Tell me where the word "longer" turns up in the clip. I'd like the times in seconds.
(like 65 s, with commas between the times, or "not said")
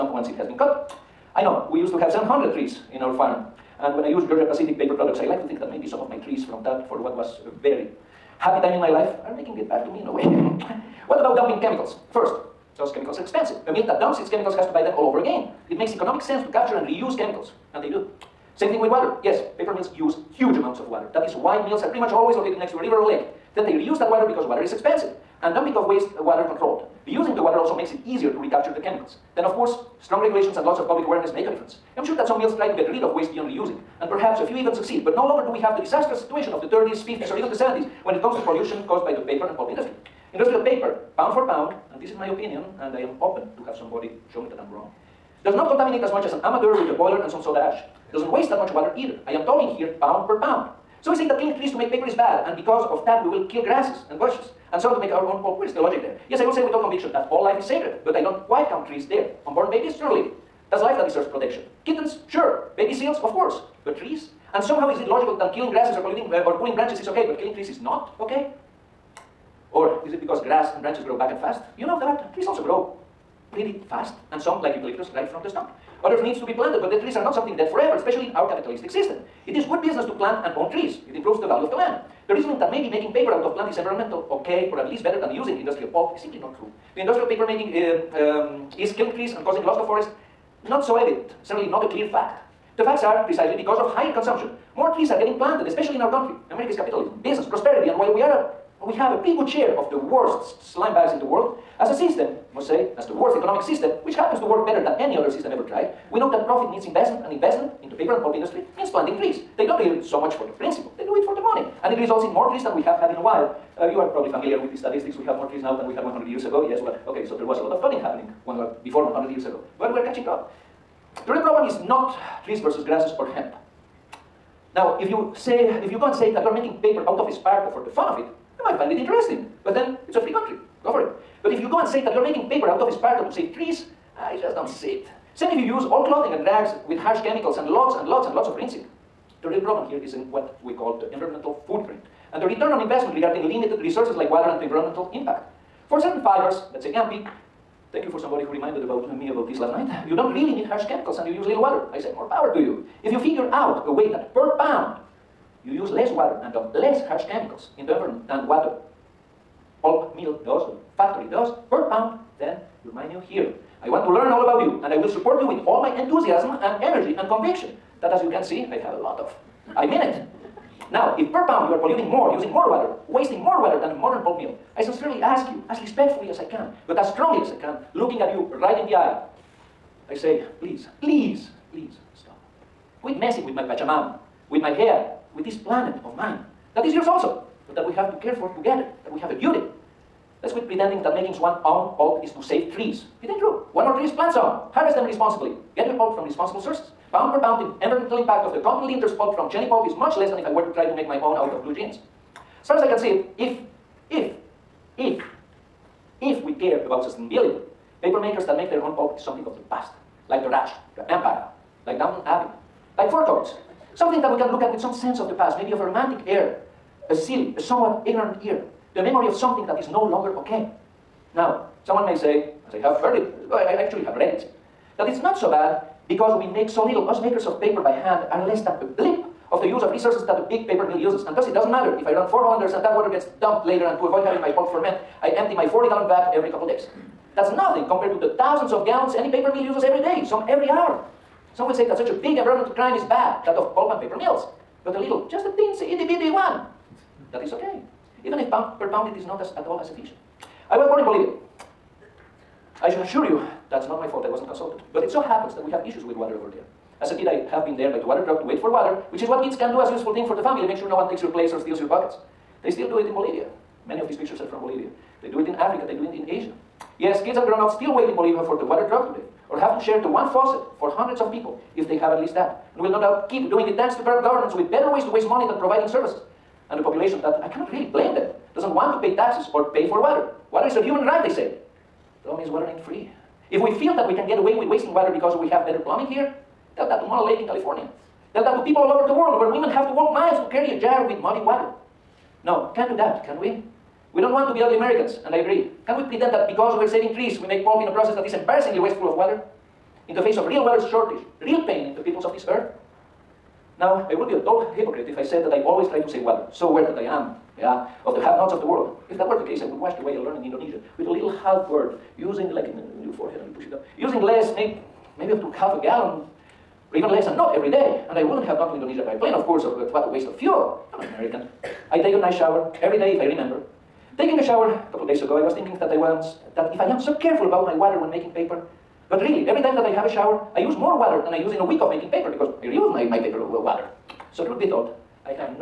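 35 s, 220 s.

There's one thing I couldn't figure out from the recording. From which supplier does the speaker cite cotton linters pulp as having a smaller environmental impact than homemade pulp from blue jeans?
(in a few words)
Cheney pulp.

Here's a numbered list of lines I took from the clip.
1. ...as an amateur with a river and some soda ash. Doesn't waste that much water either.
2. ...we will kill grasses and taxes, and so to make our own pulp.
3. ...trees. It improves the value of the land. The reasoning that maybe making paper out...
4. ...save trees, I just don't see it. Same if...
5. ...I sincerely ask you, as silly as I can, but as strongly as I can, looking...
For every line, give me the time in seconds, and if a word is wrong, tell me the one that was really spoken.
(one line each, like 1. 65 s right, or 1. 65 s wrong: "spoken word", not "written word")
1. 46 s wrong: "boiler", not "river"
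2. 53 s wrong: "bushes", not "taxes"
3. 80 s right
4. 133 s right
5. 174 s wrong: "respectfully", not "silly".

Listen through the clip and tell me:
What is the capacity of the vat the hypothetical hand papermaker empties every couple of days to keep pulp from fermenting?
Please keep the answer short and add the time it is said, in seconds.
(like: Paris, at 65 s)
40 gallons, at 235 s.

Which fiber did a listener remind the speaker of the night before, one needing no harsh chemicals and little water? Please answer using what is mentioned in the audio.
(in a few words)
Gampi.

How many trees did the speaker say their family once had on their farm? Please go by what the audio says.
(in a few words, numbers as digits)
700.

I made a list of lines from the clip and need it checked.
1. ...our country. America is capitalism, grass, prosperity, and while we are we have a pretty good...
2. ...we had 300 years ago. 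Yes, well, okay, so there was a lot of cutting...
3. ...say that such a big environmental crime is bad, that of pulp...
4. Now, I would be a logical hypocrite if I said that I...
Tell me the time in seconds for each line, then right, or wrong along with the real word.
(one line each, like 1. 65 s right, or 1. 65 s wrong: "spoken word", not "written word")
1. 96 s wrong: "business", not "grass"
2. 115 s wrong: "100", not "300"
3. 241 s right
4. 303 s wrong: "total", not "logical".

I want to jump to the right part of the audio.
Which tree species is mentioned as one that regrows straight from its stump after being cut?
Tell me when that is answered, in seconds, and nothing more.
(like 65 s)
74 s.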